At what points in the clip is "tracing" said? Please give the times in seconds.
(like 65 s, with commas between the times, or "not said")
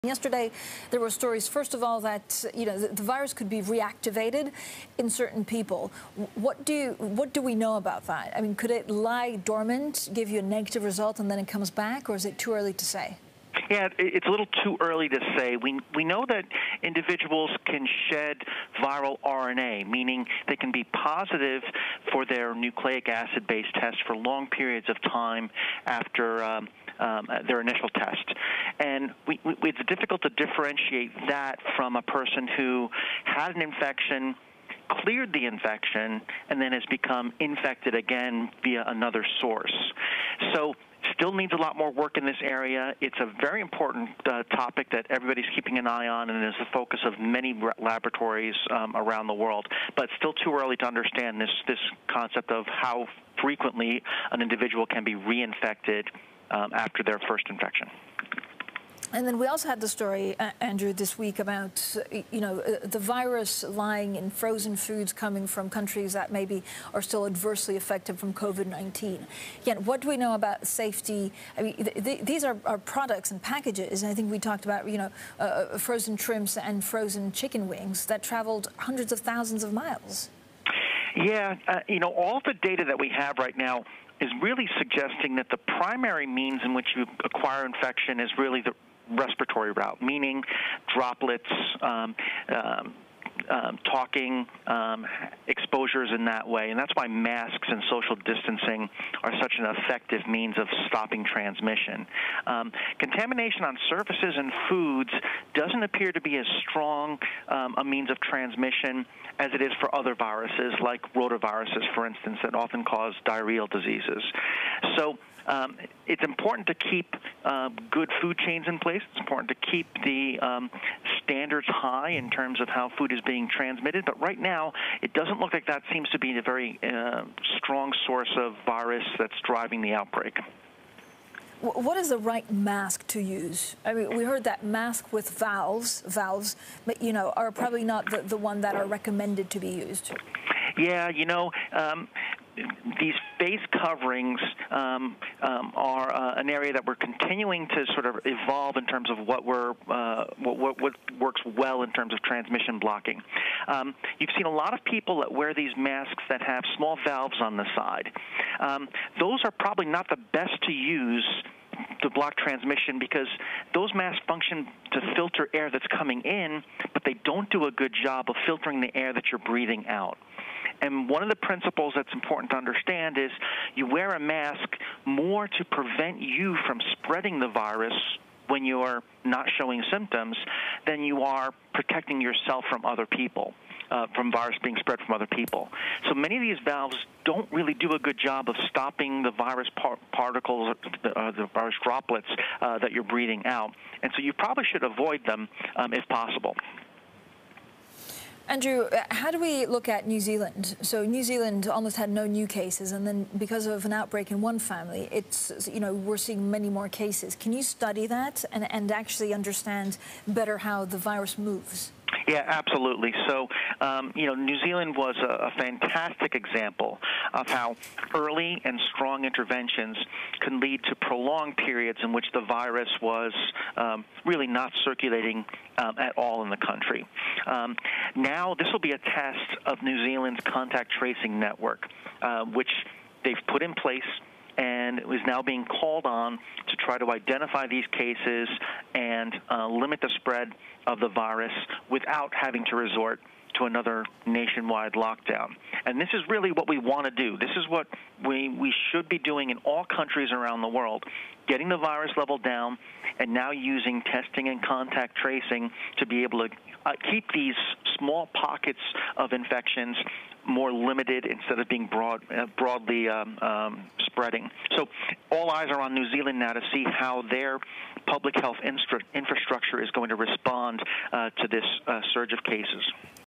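230 s, 255 s.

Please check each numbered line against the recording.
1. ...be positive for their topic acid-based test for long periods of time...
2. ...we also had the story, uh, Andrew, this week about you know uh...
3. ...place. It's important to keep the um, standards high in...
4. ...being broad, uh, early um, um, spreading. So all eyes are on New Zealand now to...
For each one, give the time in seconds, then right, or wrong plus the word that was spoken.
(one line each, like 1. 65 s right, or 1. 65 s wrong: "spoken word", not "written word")
1. 20 s wrong: "nucleic", not "topic"
2. 59 s right
3. 118 s right
4. 261 s wrong: "broadly", not "early".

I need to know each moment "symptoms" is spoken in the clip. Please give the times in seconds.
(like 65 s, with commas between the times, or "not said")
179 s.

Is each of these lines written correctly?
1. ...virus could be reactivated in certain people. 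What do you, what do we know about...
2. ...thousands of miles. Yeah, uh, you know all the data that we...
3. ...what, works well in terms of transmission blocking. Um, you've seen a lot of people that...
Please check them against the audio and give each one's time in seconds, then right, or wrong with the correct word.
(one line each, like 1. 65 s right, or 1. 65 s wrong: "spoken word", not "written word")
1. 3 s right
2. 79 s right
3. 150 s right.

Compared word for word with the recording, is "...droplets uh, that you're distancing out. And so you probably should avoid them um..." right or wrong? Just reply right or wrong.
wrong.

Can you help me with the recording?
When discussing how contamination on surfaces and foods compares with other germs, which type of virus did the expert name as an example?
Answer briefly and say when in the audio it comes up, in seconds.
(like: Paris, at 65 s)
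rotaviruses, at 111 s.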